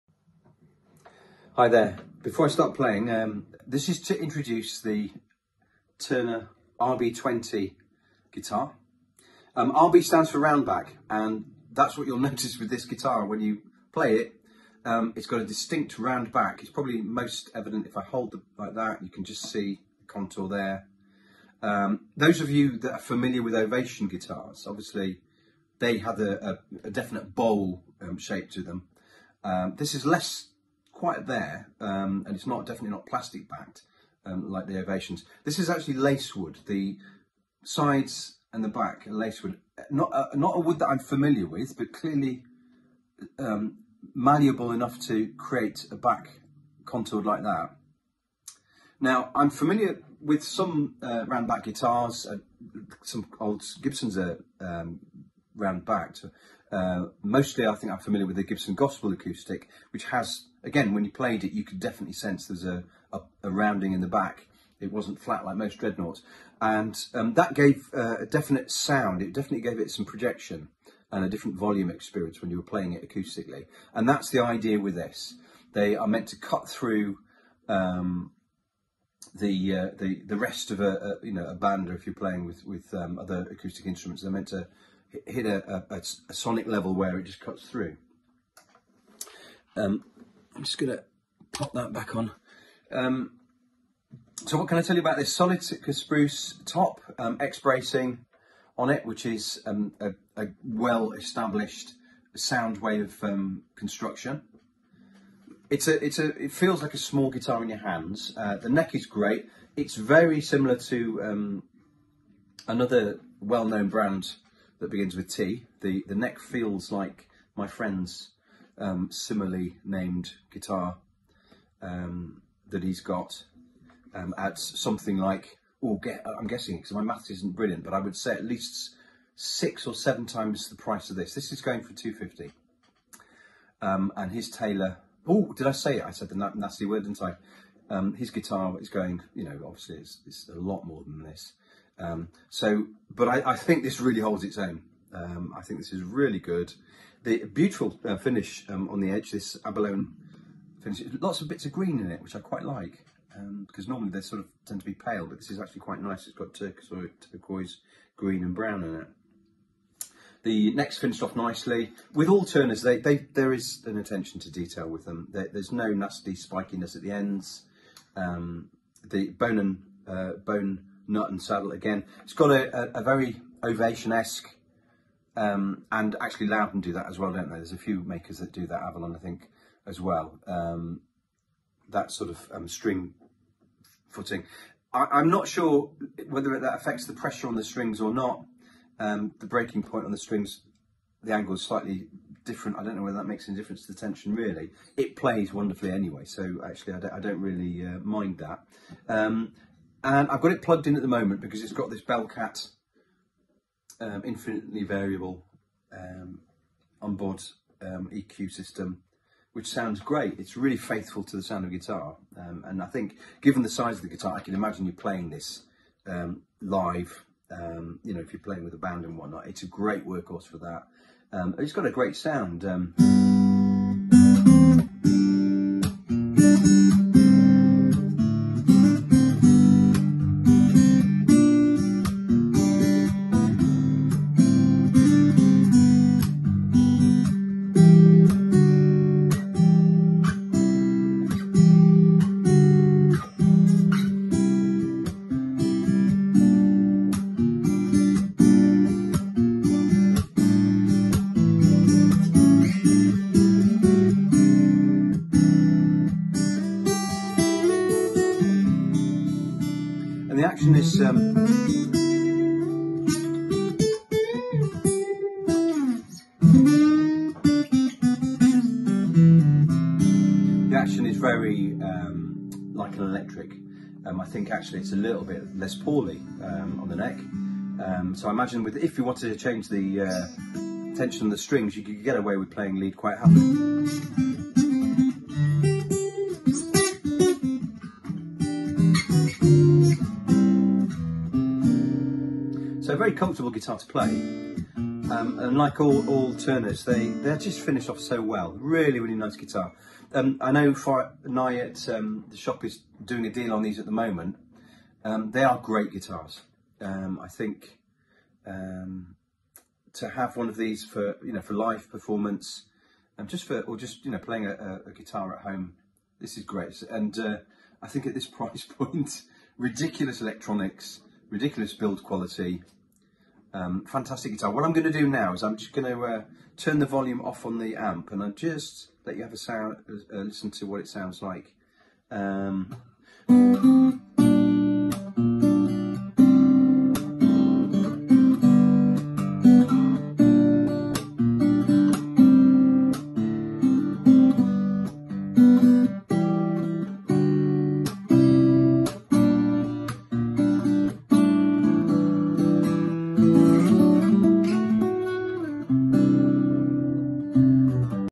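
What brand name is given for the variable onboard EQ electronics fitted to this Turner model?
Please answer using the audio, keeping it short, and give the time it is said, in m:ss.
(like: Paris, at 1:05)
Belcat, at 3:22.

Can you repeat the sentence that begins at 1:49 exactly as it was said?
It's very similar to um, another well-known brand that begins with T.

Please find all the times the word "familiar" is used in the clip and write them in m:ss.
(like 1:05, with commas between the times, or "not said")
0:22, 0:40, 0:49, 0:57.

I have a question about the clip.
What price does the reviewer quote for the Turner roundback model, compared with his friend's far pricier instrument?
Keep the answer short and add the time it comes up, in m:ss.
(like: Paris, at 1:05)
250, at 2:11.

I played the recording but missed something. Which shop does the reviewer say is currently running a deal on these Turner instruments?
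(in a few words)
Nye.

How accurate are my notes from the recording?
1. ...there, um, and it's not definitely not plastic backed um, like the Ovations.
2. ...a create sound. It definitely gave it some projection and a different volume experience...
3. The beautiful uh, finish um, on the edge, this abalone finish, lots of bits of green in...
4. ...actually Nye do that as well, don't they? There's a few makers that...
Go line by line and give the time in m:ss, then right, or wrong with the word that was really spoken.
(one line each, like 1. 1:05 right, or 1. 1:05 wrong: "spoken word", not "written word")
1. 0:31 right
2. 1:08 wrong: "definite", not "create"
3. 2:27 right
4. 2:56 wrong: "Lowden", not "Nye".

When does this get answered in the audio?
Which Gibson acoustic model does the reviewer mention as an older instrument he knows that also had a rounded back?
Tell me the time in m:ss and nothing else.
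0:58.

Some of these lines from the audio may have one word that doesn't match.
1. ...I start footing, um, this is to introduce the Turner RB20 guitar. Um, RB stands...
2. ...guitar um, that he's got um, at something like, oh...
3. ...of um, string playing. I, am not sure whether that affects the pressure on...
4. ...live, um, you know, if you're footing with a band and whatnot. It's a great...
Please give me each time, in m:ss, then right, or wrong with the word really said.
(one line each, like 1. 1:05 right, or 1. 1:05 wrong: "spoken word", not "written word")
1. 0:02 wrong: "playing", not "footing"
2. 2:00 right
3. 3:02 wrong: "footing", not "playing"
4. 3:36 wrong: "playing", not "footing".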